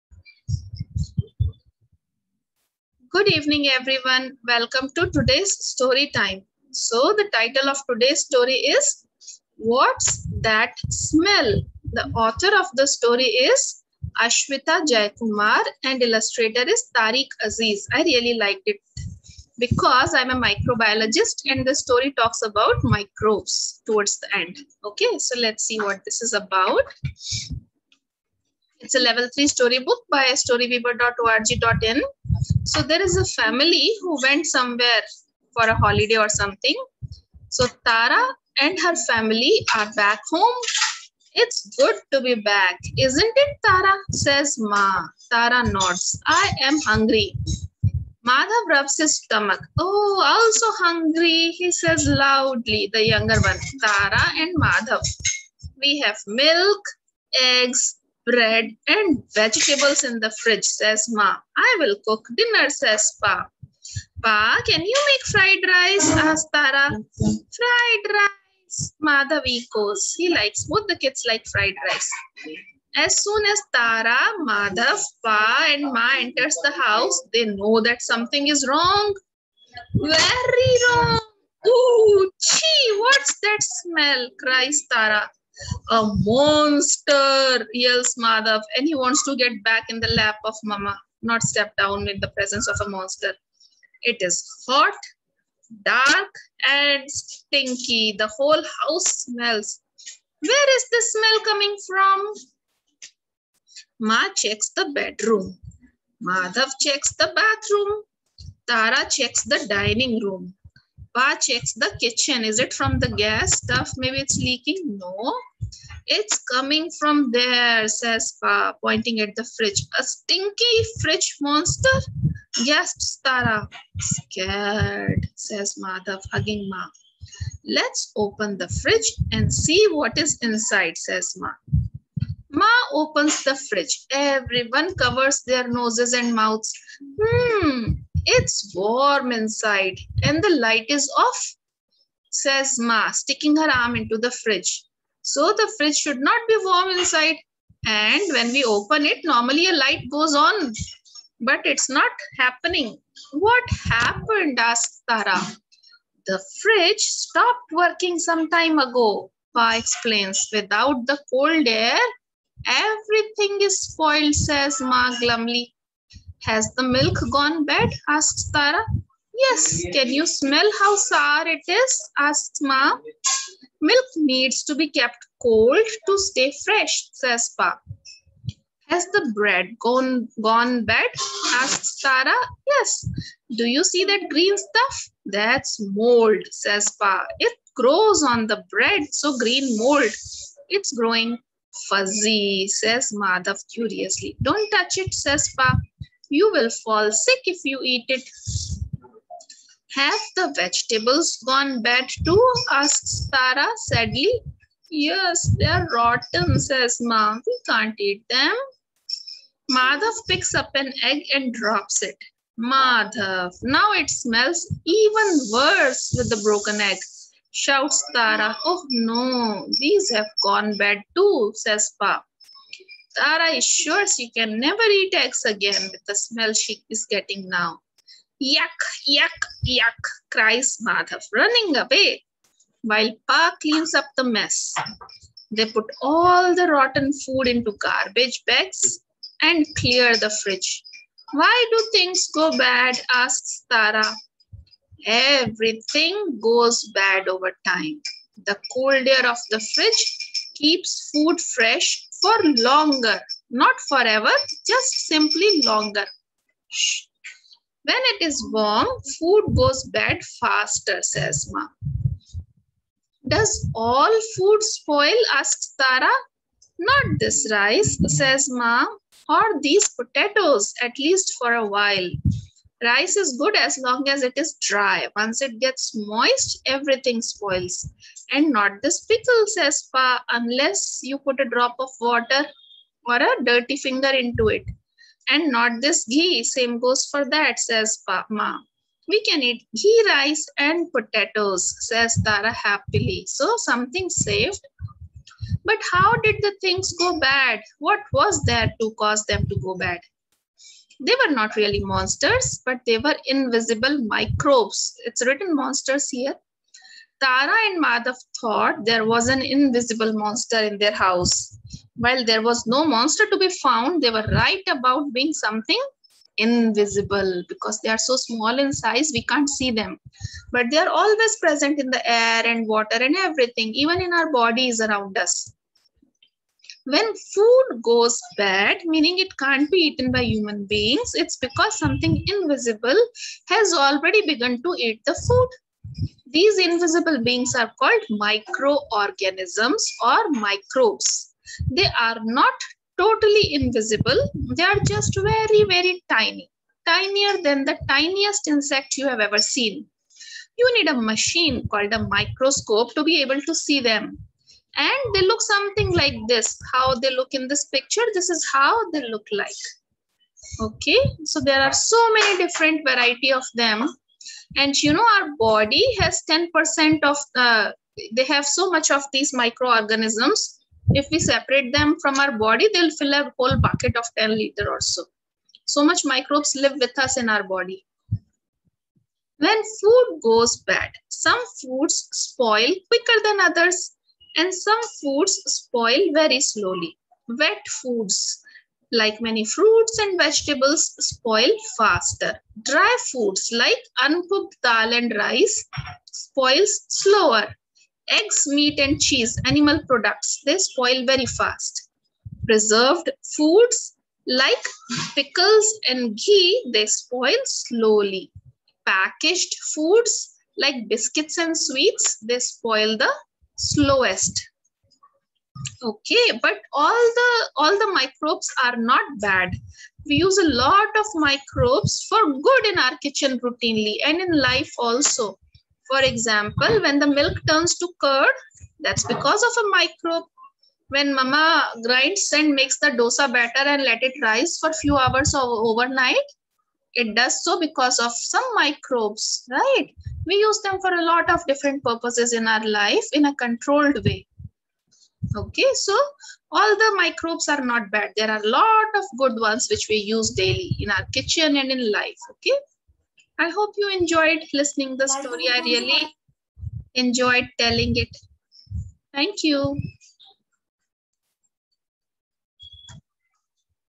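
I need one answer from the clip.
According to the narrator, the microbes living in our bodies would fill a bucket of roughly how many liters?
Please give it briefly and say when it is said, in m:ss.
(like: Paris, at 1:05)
10, at 6:14.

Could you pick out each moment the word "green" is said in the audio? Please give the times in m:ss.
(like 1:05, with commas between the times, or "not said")
3:04, 3:09.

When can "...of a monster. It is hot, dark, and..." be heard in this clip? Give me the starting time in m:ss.
1:32.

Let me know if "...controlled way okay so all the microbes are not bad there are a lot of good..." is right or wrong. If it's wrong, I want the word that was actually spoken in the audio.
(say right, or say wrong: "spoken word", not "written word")
right.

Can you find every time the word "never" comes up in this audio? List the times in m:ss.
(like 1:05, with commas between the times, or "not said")
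3:44.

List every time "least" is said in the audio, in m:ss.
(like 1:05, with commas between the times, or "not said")
4:30.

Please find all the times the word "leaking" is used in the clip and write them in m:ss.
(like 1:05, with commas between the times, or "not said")
1:54.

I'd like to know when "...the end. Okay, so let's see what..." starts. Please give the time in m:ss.
0:24.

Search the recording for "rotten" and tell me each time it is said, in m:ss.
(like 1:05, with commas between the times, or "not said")
3:25, 3:56.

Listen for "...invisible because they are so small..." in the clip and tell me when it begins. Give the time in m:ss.
5:16.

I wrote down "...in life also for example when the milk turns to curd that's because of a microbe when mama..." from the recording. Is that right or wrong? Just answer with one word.
right.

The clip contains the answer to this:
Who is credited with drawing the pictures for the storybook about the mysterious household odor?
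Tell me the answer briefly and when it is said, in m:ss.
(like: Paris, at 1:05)
Tariq Aziz, at 0:16.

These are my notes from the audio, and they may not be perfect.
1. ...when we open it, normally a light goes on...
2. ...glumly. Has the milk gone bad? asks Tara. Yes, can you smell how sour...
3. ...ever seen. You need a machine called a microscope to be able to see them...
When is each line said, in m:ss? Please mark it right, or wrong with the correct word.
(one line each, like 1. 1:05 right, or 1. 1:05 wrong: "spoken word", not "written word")
1. 2:28 right
2. 2:45 right
3. 5:49 right.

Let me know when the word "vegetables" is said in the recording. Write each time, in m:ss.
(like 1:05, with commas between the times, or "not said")
0:59, 3:20, 6:30.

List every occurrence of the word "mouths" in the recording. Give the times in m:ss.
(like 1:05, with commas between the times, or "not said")
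2:16.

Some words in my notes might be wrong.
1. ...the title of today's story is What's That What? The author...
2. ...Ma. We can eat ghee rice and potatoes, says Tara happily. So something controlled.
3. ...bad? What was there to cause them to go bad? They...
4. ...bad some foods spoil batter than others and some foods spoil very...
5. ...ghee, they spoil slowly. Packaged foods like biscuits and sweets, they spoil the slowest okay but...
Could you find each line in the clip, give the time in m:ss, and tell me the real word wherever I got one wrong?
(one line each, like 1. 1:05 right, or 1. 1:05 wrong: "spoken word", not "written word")
1. 0:07 wrong: "Smell", not "What"
2. 4:48 wrong: "saved", not "controlled"
3. 4:57 right
4. 6:20 wrong: "quicker", not "batter"
5. 6:46 right.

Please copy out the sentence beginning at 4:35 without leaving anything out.
Once it gets moist, everything spoils.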